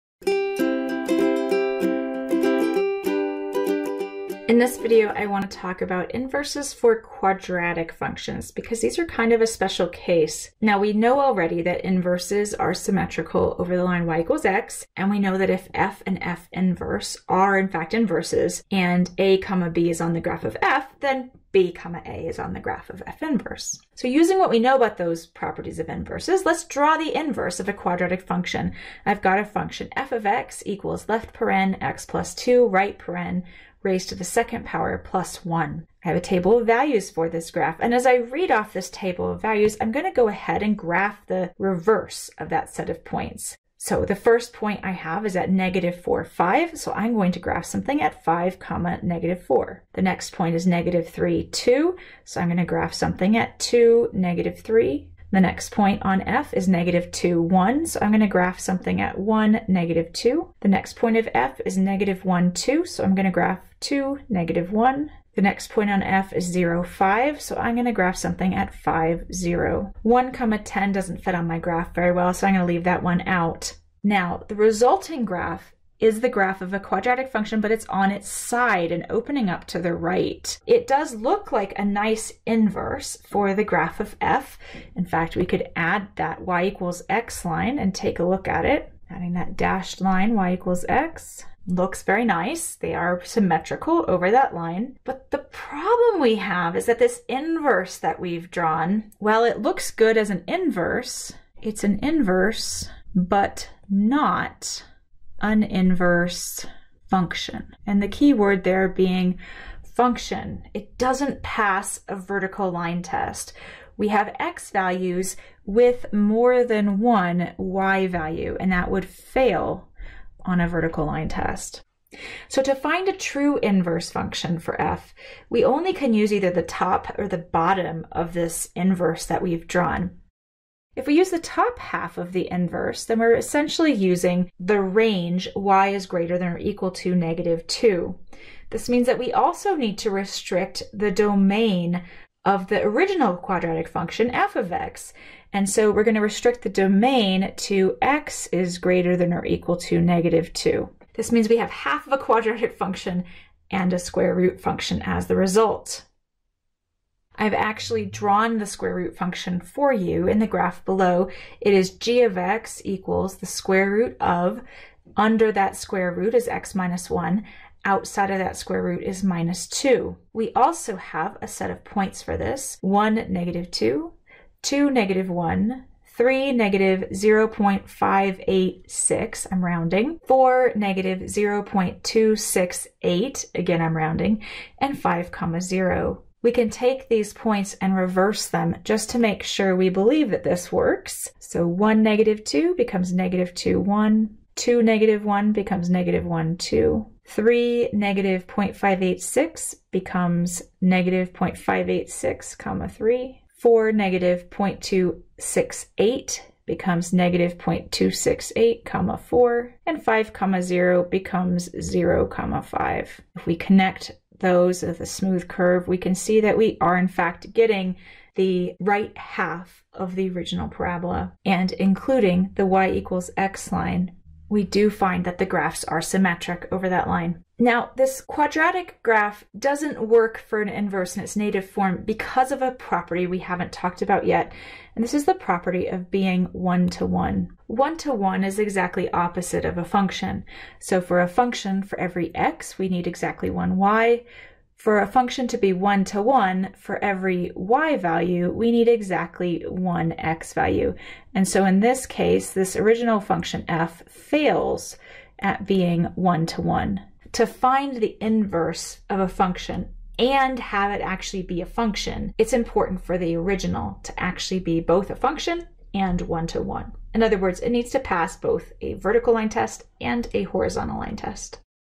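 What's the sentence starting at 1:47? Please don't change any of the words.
And the key word there being function.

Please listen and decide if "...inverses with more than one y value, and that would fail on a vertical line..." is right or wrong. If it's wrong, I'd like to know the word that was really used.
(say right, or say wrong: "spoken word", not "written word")
wrong: "values", not "inverses".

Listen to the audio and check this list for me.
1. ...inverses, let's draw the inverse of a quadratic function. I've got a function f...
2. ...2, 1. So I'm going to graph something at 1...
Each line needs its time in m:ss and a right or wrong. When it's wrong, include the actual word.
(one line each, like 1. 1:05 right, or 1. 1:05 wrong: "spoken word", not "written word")
1. 0:25 right
2. 0:57 right.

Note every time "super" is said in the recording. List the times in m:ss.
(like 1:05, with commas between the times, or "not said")
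not said.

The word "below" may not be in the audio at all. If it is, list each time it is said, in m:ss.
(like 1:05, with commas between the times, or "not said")
2:40.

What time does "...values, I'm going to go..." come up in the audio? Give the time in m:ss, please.
0:39.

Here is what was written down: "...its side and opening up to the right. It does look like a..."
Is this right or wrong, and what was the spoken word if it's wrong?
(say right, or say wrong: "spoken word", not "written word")
right.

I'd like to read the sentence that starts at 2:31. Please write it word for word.
This means we have half of a quadratic function and a square root function as the result.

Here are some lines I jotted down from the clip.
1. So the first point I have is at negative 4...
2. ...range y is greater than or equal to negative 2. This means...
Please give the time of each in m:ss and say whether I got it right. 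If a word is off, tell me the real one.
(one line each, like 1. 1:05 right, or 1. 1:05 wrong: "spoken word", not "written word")
1. 0:43 right
2. 2:14 right.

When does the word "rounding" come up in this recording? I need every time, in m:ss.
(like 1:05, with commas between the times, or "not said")
2:59, 3:03.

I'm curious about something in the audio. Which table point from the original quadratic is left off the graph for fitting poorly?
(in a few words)
(1, 10).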